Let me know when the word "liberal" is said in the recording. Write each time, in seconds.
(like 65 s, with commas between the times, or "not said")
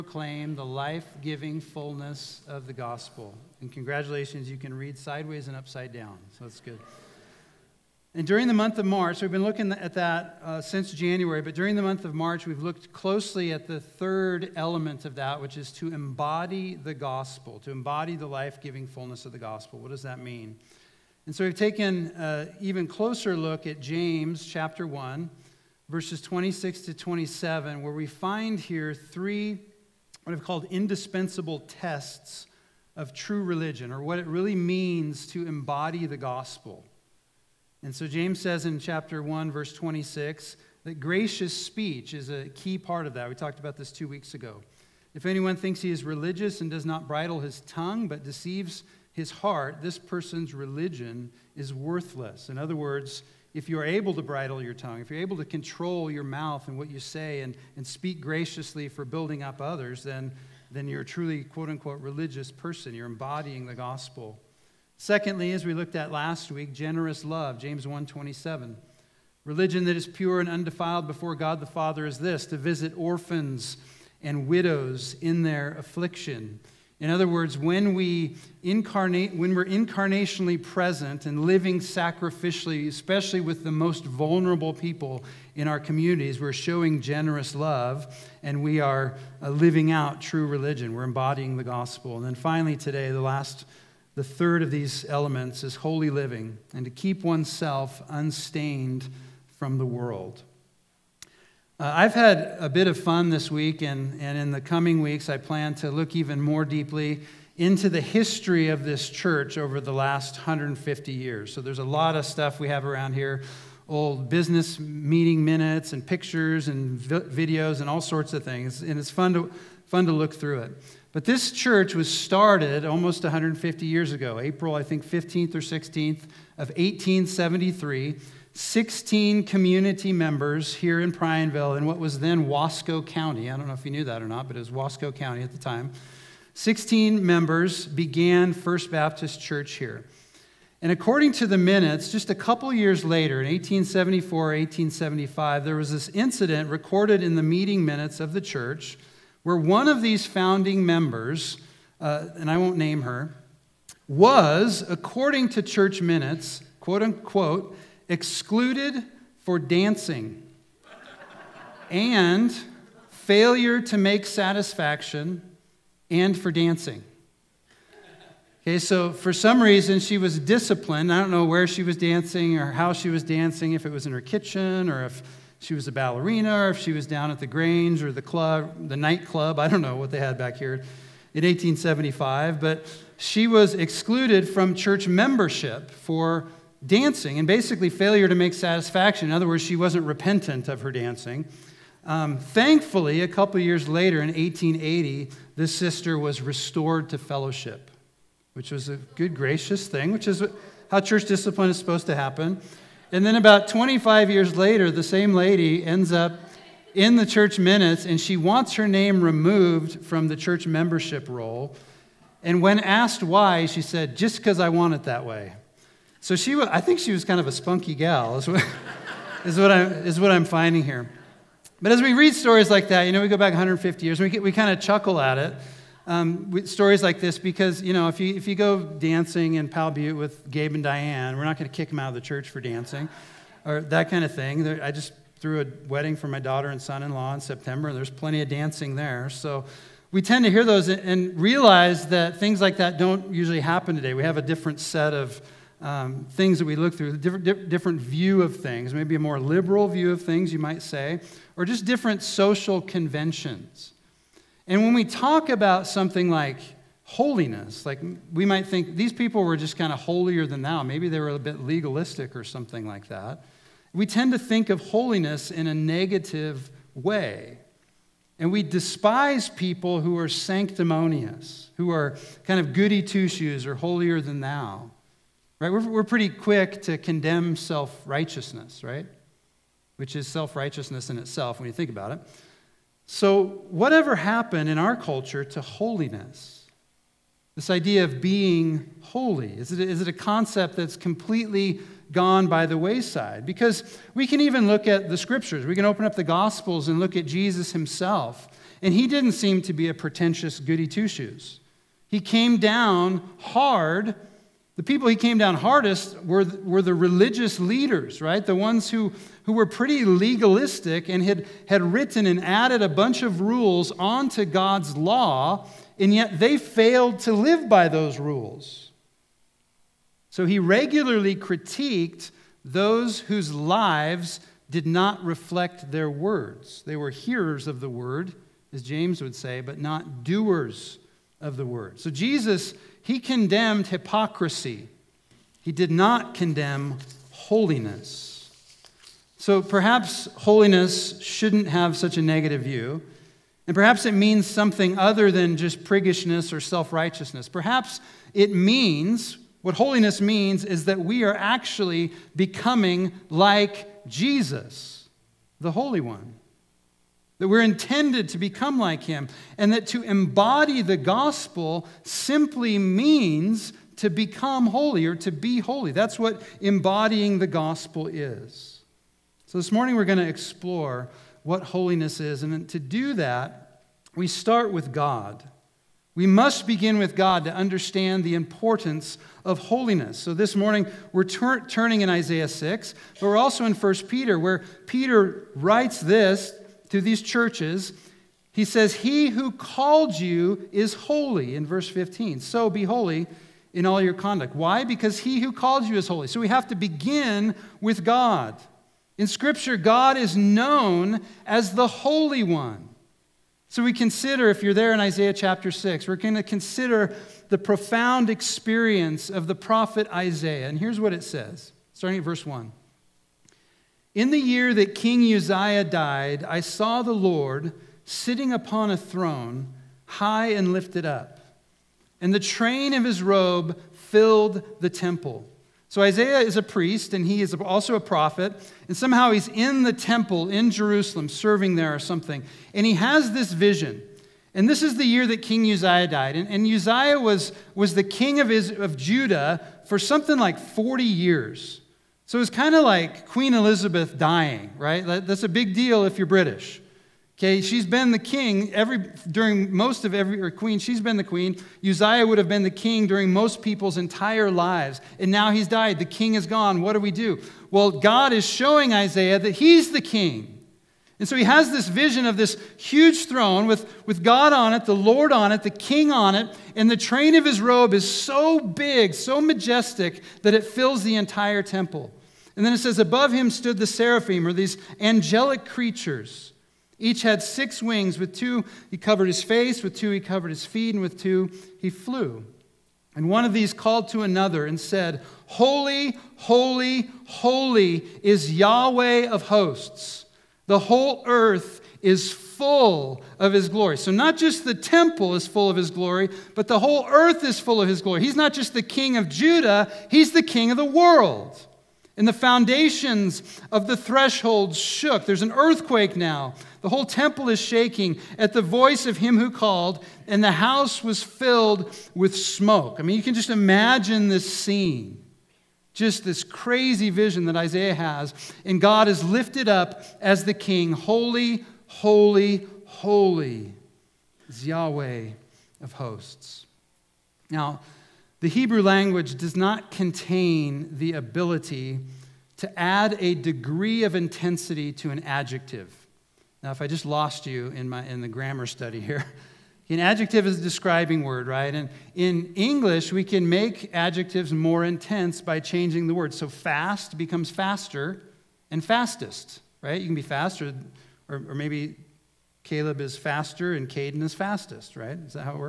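249 s.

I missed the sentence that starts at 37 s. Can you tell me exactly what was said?
And so James says in chapter 1, verse 26, that gracious speech is a key part of that.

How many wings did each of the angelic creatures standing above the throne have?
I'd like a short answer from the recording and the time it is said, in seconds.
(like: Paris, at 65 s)
6, at 477 s.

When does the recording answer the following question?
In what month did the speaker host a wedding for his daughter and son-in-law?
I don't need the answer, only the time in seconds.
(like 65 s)
237 s.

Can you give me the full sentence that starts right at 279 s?
Which is self righteousness in itself when you think about it.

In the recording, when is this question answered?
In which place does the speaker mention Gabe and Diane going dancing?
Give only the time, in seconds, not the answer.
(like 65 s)
229 s.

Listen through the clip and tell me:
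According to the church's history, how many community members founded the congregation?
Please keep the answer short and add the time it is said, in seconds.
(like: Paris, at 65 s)
16, at 128 s.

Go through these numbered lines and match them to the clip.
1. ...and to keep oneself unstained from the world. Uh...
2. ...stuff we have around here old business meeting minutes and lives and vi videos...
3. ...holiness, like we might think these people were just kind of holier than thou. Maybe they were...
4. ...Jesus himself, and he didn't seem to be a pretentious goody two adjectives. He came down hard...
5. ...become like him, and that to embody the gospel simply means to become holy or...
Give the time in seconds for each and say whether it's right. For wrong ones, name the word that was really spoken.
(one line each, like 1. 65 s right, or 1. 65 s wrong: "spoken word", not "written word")
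1. 96 s right
2. 112 s wrong: "pictures", not "lives"
3. 257 s right
4. 297 s wrong: "shoes", not "adjectives"
5. 358 s right.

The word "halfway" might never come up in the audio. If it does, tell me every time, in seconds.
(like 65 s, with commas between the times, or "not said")
not said.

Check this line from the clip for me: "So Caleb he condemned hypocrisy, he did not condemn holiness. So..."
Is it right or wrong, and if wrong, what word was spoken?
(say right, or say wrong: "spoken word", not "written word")
wrong: "Jesus", not "Caleb".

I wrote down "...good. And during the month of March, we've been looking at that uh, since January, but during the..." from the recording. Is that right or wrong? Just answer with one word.
right.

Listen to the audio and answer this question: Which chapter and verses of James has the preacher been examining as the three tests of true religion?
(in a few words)
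Chapter 1, verses 26 to 27.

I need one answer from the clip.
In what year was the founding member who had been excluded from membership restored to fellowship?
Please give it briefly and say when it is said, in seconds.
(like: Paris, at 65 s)
1880, at 194 s.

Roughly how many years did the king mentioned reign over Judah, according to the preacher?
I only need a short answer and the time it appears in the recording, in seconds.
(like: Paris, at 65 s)
40, at 440 s.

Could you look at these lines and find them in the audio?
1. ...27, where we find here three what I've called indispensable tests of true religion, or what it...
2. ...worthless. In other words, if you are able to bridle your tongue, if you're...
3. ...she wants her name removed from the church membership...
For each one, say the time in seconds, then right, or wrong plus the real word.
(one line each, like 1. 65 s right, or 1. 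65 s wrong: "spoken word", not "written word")
1. 26 s right
2. 51 s right
3. 208 s right.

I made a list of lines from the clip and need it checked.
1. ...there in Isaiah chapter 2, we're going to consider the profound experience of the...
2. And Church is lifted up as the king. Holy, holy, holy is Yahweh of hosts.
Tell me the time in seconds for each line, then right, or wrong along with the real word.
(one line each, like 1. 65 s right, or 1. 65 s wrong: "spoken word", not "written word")
1. 404 s wrong: "6", not "2"
2. 518 s wrong: "God", not "Church".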